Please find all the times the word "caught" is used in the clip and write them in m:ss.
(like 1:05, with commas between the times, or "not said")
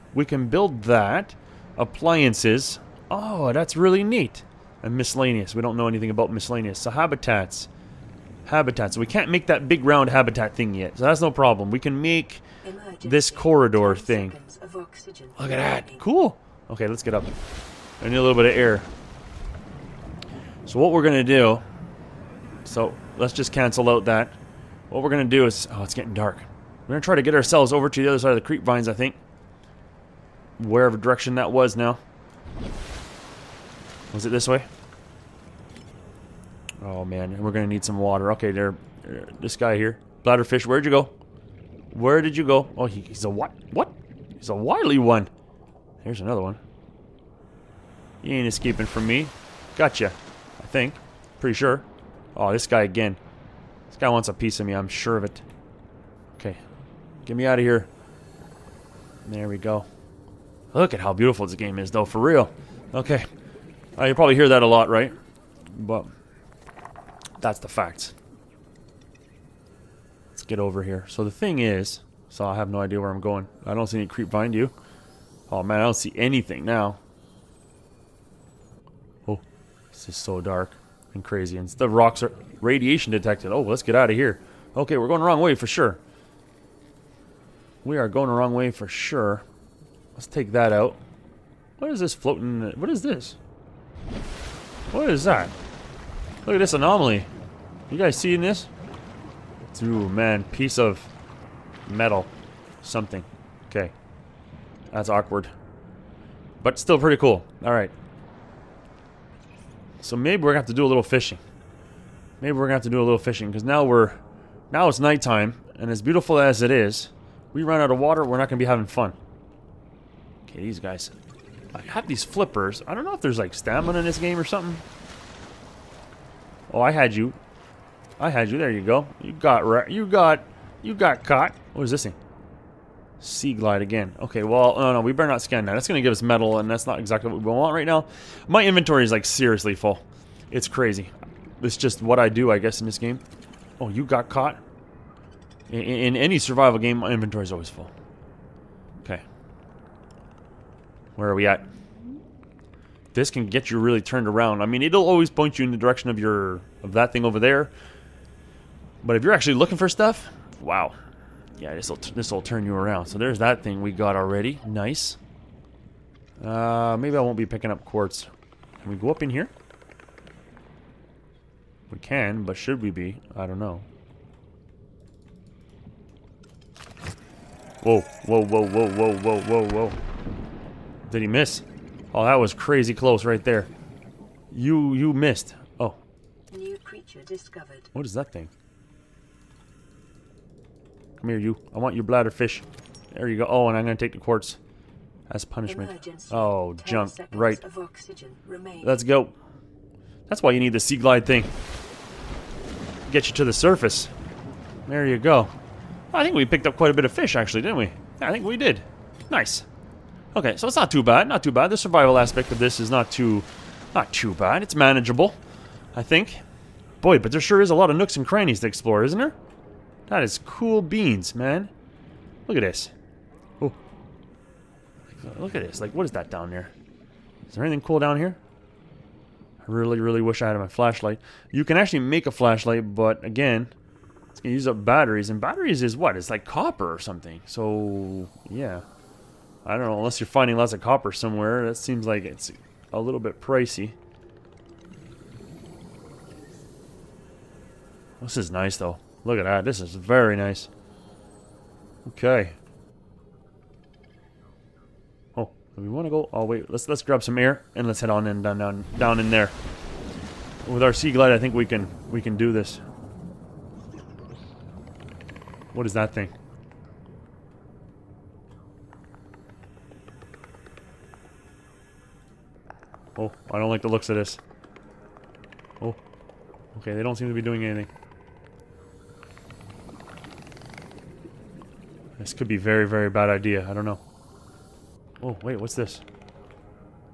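2:11, 2:24.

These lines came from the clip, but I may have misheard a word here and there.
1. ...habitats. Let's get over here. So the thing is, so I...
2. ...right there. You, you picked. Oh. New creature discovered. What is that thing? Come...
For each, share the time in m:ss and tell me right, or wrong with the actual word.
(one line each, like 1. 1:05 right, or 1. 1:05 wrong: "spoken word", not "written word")
1. 1:07 wrong: "facts", not "habitats"
2. 3:03 wrong: "missed", not "picked".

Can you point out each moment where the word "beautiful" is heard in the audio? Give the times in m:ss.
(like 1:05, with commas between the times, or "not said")
1:01, 1:56.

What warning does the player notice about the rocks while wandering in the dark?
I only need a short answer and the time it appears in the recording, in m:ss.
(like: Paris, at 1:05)
radiation detected, at 1:22.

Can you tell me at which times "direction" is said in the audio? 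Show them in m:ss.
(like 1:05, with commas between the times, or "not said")
0:30, 2:35.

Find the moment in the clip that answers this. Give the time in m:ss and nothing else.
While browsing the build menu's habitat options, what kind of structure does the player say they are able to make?
0:13.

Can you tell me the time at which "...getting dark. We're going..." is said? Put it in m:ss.
0:25.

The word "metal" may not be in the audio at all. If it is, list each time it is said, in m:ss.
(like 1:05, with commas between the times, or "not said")
1:41, 2:16.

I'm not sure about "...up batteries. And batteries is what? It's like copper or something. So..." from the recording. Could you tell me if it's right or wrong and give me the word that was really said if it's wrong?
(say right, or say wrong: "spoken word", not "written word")
right.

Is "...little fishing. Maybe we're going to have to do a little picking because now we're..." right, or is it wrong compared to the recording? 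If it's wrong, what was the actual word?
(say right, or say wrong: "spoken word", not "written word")
wrong: "fishing", not "picking".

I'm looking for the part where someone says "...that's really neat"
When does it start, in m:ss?
0:03.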